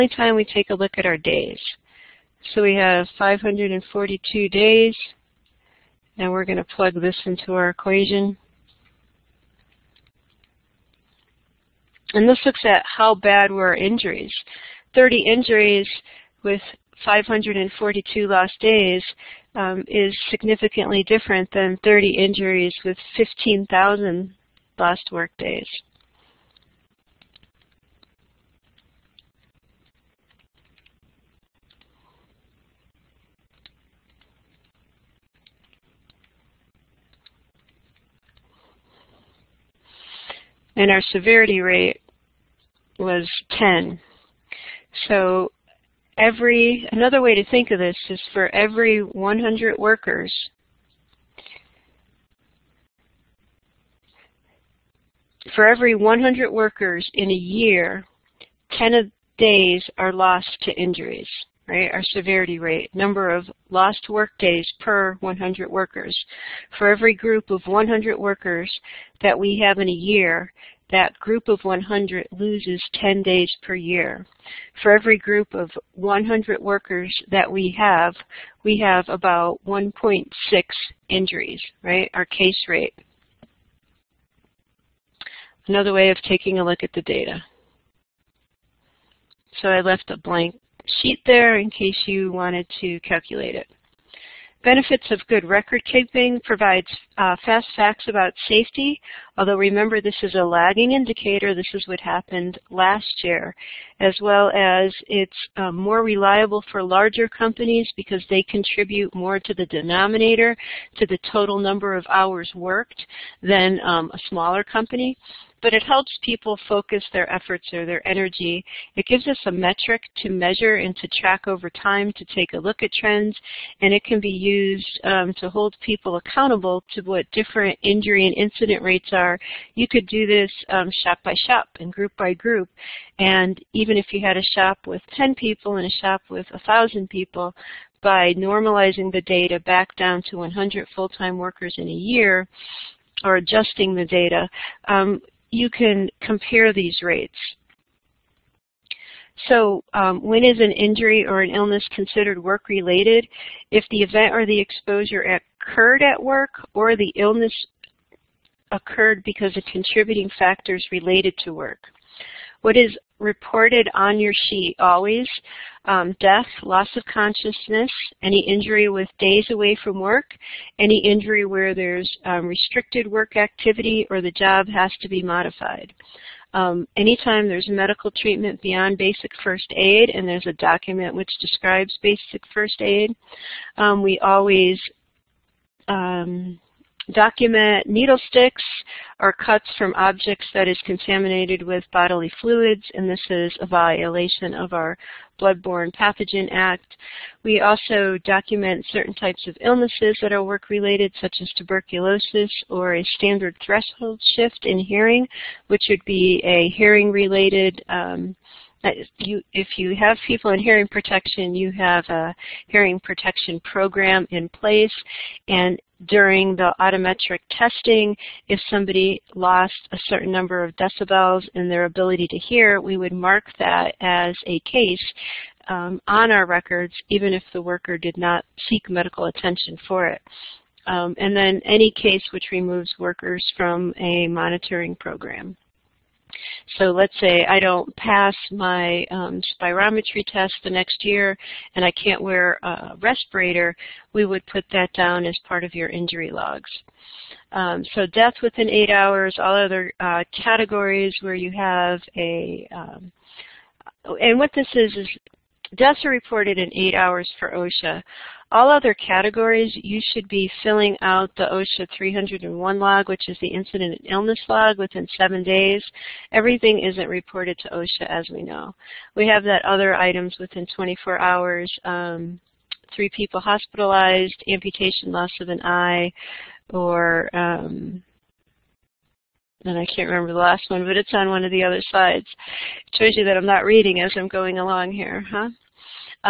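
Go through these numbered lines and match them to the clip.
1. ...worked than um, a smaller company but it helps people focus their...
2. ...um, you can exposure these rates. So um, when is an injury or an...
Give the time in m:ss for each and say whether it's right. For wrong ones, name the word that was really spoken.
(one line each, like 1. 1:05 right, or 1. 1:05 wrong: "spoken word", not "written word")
1. 1:52 right
2. 2:24 wrong: "compare", not "exposure".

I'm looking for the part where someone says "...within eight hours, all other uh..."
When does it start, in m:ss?
4:08.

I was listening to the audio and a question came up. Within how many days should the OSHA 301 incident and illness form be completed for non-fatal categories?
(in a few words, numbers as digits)
7 days.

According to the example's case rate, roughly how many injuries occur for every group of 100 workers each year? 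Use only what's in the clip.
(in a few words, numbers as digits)
1.6.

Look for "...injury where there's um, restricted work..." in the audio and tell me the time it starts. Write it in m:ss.
2:51.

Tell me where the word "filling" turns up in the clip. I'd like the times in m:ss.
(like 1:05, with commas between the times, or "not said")
4:20.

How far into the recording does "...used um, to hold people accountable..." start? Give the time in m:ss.
2:04.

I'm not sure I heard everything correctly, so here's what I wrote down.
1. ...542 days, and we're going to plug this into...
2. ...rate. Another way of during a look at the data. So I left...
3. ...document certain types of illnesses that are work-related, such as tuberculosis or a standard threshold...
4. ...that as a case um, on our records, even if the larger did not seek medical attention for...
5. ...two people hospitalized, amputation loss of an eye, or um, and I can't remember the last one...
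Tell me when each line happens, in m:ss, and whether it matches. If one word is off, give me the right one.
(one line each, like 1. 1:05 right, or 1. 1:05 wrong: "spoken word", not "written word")
1. 0:03 right
2. 1:22 wrong: "taking", not "during"
3. 3:18 right
4. 3:43 wrong: "worker", not "larger"
5. 4:32 wrong: "three", not "two".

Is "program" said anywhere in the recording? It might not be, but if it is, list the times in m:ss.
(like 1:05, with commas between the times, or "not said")
3:33, 3:54.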